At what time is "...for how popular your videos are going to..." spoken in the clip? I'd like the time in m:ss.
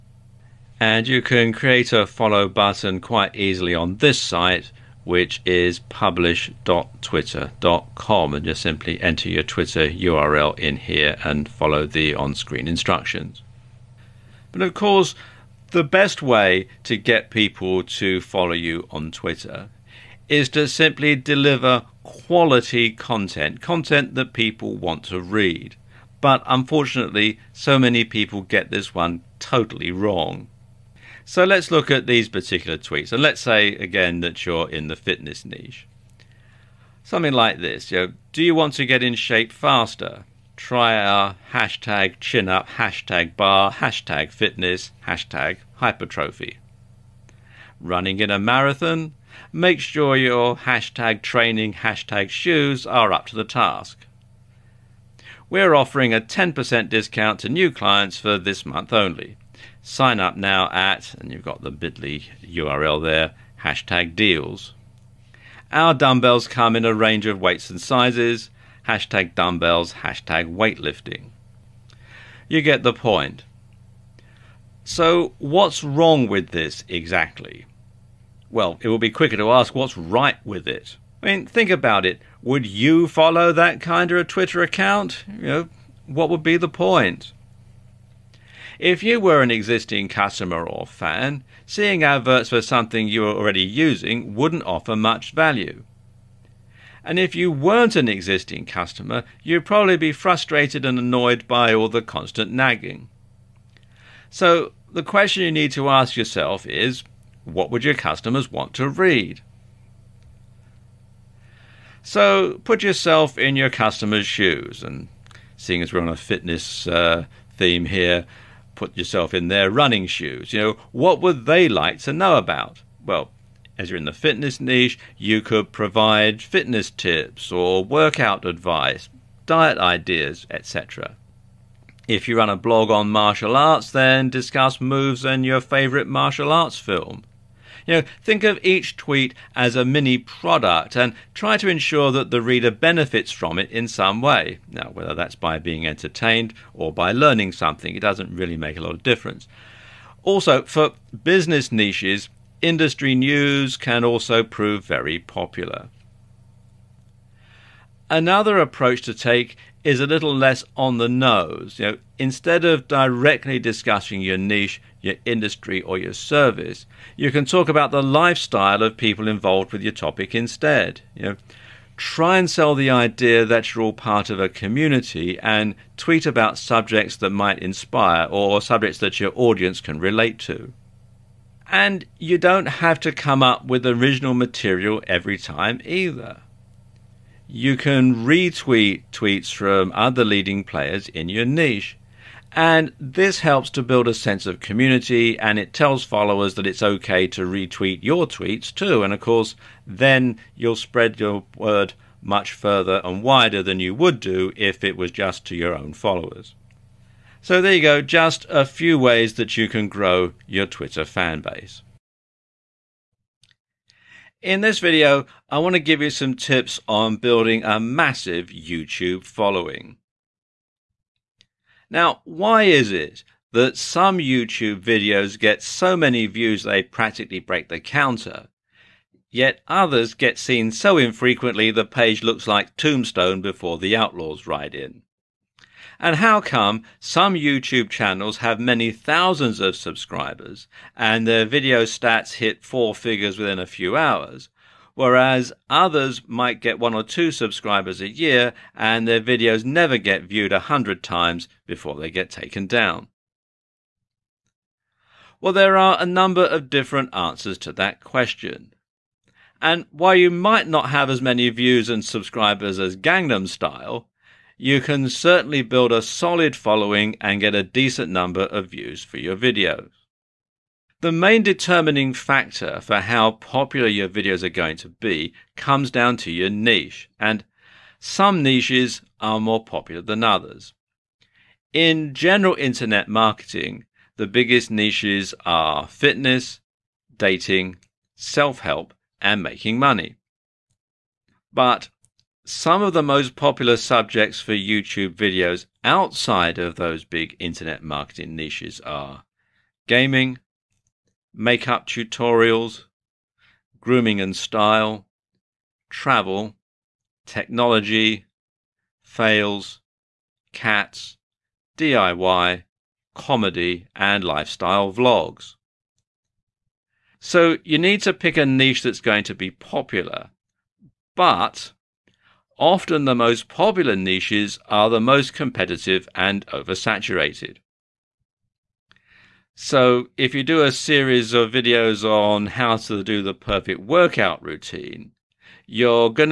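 4:32.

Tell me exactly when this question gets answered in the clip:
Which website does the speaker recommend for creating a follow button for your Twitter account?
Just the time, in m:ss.
0:05.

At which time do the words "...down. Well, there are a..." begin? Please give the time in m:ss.
4:12.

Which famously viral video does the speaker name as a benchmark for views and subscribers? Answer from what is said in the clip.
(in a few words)
Gangnam Style.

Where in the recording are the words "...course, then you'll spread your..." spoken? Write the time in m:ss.
3:19.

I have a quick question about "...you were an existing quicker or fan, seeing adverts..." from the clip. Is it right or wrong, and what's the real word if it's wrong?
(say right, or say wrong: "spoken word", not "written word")
wrong: "customer", not "quicker".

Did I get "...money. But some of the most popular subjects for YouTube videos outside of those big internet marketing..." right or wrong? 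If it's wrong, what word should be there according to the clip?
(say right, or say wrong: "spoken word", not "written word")
right.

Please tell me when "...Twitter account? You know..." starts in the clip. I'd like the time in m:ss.
1:24.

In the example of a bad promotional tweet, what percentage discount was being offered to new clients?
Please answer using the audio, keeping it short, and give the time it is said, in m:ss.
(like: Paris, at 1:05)
10%, at 0:56.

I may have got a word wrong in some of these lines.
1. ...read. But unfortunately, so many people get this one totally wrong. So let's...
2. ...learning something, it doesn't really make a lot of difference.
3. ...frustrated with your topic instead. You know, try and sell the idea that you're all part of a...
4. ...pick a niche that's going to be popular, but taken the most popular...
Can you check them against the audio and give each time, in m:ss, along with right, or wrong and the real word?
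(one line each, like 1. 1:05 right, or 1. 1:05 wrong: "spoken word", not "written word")
1. 0:25 right
2. 2:27 right
3. 2:49 wrong: "involved", not "frustrated"
4. 5:18 wrong: "often", not "taken".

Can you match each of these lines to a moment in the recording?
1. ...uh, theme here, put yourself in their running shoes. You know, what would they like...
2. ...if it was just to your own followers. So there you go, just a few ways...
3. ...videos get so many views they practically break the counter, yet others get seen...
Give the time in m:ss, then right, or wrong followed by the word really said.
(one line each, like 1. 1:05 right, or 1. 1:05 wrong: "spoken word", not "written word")
1. 1:56 right
2. 3:24 right
3. 3:44 right.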